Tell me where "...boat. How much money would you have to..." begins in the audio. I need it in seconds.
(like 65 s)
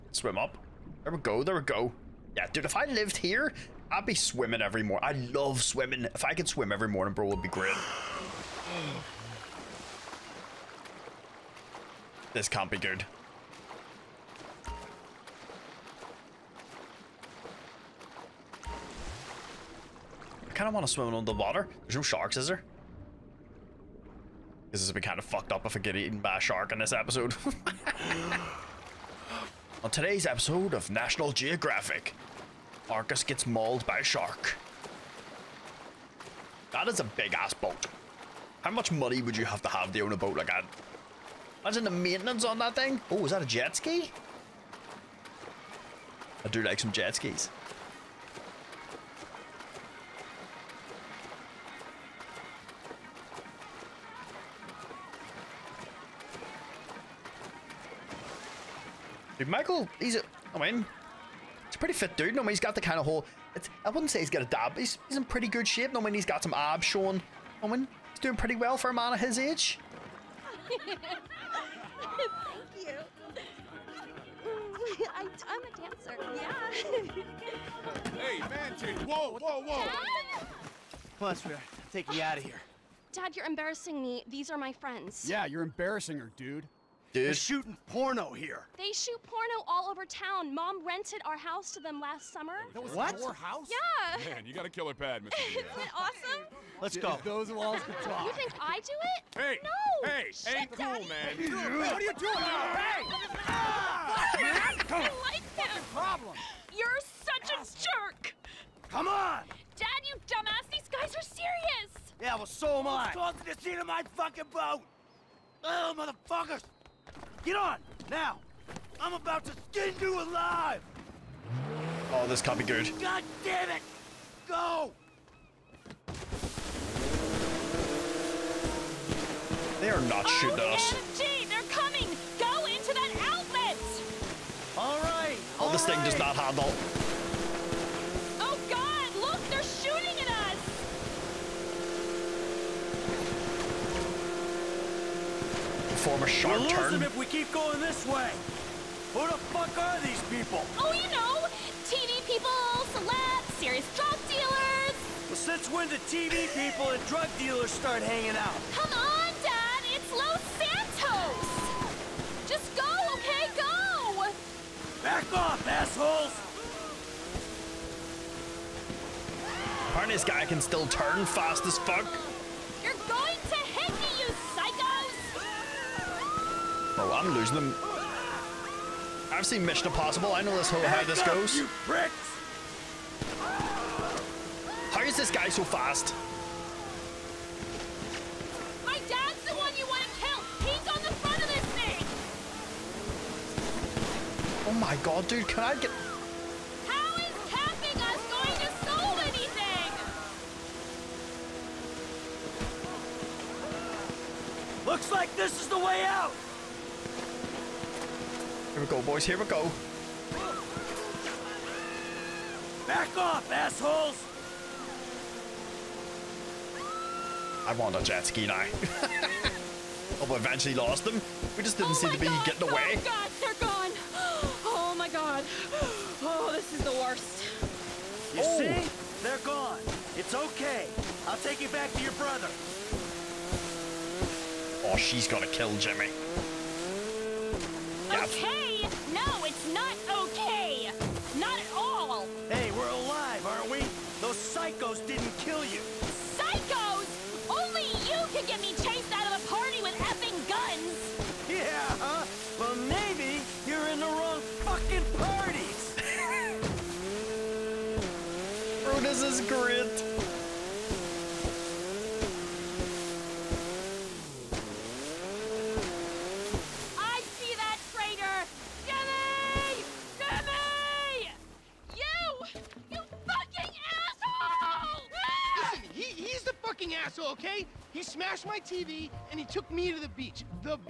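37 s.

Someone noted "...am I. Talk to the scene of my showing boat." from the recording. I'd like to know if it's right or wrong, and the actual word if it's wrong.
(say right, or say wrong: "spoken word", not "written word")
wrong: "fucking", not "showing".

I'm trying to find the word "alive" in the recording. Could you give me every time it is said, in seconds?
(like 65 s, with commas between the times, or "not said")
120 s.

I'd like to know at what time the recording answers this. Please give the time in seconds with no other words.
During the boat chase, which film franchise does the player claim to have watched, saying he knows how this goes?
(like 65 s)
179 s.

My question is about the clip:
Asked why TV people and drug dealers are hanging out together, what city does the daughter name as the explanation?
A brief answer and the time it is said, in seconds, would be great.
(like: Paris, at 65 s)
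Los Santos, at 160 s.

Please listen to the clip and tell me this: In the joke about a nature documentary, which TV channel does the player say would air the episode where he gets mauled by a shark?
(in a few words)
National Geographic.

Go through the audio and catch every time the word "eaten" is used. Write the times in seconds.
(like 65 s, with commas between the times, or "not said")
25 s.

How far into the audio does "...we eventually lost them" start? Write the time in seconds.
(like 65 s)
220 s.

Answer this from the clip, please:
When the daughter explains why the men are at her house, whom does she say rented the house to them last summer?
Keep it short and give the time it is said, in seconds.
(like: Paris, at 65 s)
Mom, at 90 s.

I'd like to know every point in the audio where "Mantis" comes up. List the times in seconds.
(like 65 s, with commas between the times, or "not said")
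78 s.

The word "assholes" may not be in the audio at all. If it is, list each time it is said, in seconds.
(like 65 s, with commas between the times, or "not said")
165 s, 213 s, 277 s.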